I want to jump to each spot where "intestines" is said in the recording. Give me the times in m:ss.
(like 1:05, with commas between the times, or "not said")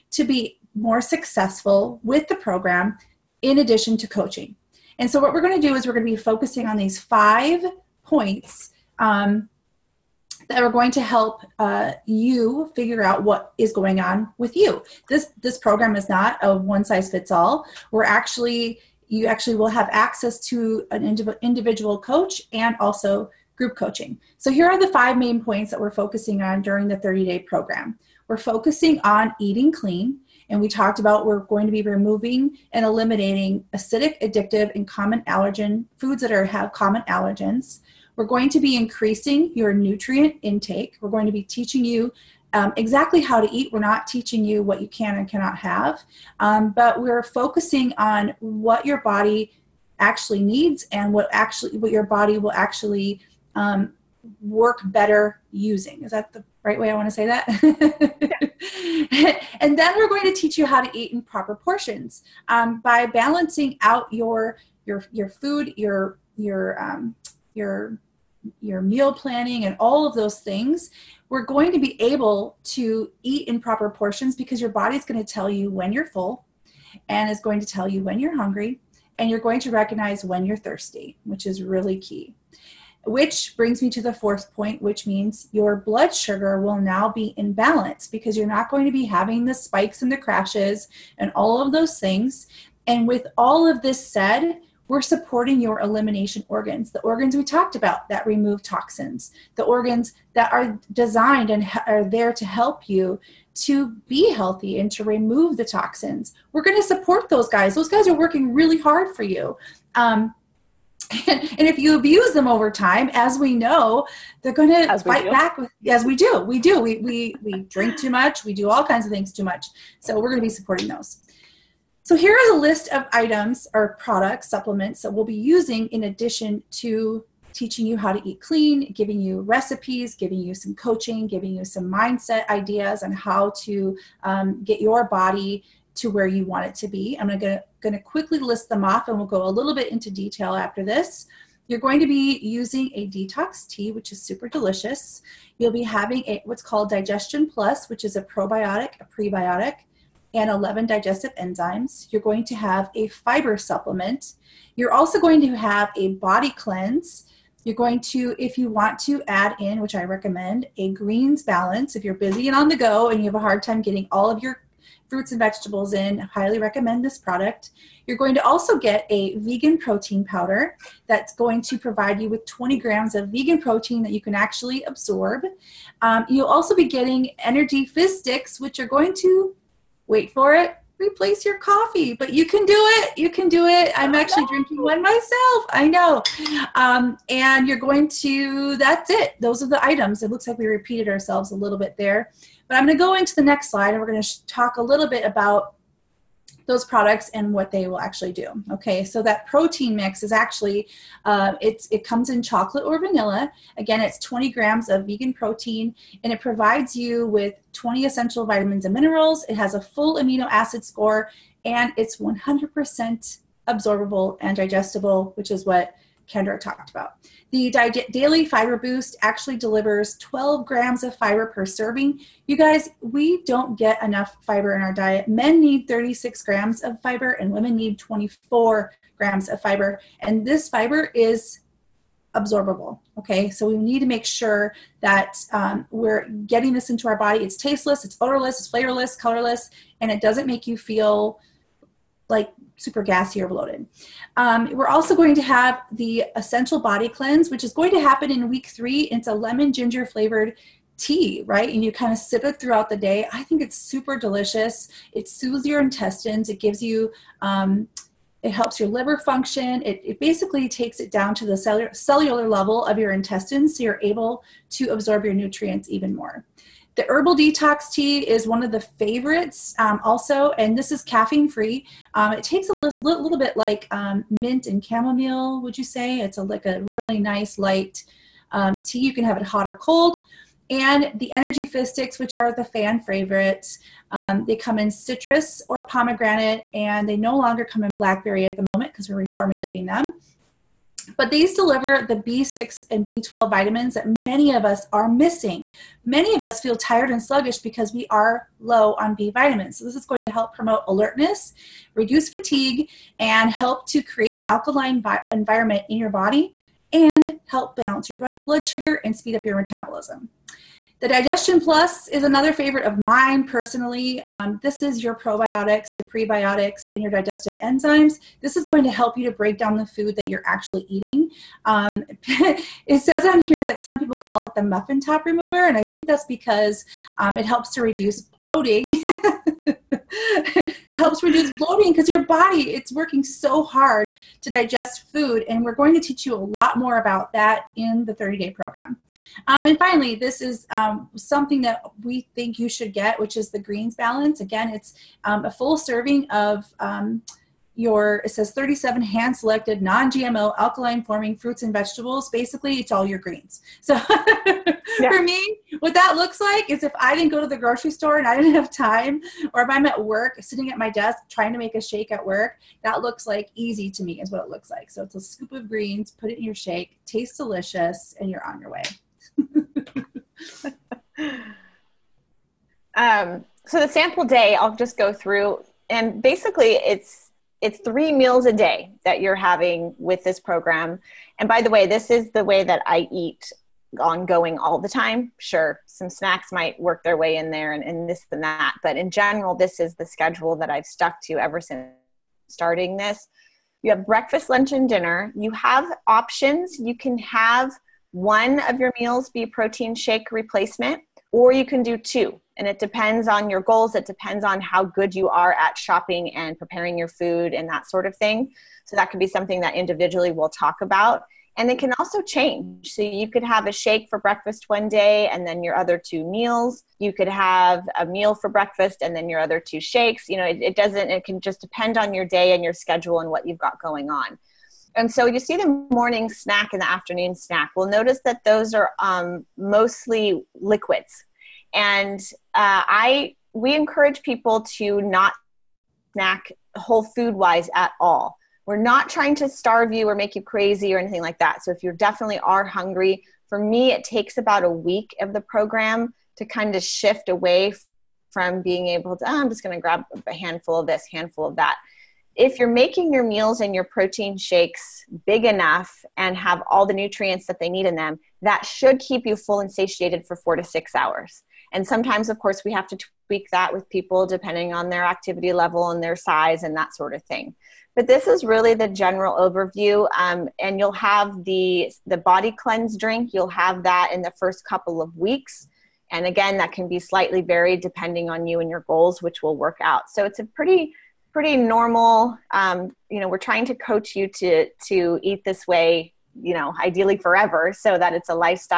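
4:15, 4:23.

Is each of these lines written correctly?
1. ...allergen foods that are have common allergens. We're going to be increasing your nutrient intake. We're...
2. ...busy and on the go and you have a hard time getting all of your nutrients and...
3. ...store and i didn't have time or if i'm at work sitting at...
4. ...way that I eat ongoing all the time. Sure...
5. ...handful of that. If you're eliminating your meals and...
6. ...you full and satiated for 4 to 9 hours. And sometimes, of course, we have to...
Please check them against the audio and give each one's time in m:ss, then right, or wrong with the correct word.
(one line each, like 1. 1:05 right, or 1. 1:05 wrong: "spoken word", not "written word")
1. 0:35 right
2. 2:42 wrong: "fruits", not "nutrients"
3. 5:57 right
4. 6:22 right
5. 7:31 wrong: "making", not "eliminating"
6. 7:39 wrong: "6", not "9".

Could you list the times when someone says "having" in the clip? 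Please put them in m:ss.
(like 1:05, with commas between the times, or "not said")
1:29, 2:25, 6:19.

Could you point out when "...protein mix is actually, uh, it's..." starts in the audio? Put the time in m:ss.
3:19.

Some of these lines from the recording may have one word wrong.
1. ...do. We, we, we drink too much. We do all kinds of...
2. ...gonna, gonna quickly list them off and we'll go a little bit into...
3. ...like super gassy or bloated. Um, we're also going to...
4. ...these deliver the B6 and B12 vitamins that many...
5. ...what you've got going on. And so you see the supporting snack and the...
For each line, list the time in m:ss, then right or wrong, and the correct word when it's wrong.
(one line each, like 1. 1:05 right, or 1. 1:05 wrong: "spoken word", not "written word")
1. 1:56 right
2. 2:17 right
3. 4:02 right
4. 4:51 right
5. 7:03 wrong: "morning", not "supporting".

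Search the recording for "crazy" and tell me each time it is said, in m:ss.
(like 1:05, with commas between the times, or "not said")
7:20.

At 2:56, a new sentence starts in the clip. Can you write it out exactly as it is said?
Um, you'll also be getting energy fizz sticks, which are going to wait for it, replace your coffee.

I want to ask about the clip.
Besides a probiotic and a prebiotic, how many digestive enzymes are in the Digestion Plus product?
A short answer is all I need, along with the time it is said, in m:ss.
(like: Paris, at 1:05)
11, at 2:30.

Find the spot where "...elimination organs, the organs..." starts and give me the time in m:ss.
1:35.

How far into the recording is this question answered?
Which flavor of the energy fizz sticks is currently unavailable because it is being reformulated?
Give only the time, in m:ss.
4:47.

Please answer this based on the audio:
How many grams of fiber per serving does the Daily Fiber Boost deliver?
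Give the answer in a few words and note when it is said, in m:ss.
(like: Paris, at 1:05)
12, at 3:40.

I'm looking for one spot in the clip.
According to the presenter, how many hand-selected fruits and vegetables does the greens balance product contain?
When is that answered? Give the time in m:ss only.
5:48.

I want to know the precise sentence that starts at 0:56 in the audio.
Is that the right way I want to say that?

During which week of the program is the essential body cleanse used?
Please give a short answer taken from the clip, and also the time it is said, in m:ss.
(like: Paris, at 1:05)
week three, at 4:08.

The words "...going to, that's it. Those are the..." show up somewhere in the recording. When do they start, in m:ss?
3:07.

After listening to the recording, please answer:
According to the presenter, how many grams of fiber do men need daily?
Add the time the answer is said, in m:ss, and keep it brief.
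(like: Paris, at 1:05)
36, at 3:45.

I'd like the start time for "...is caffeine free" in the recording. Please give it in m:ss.
4:30.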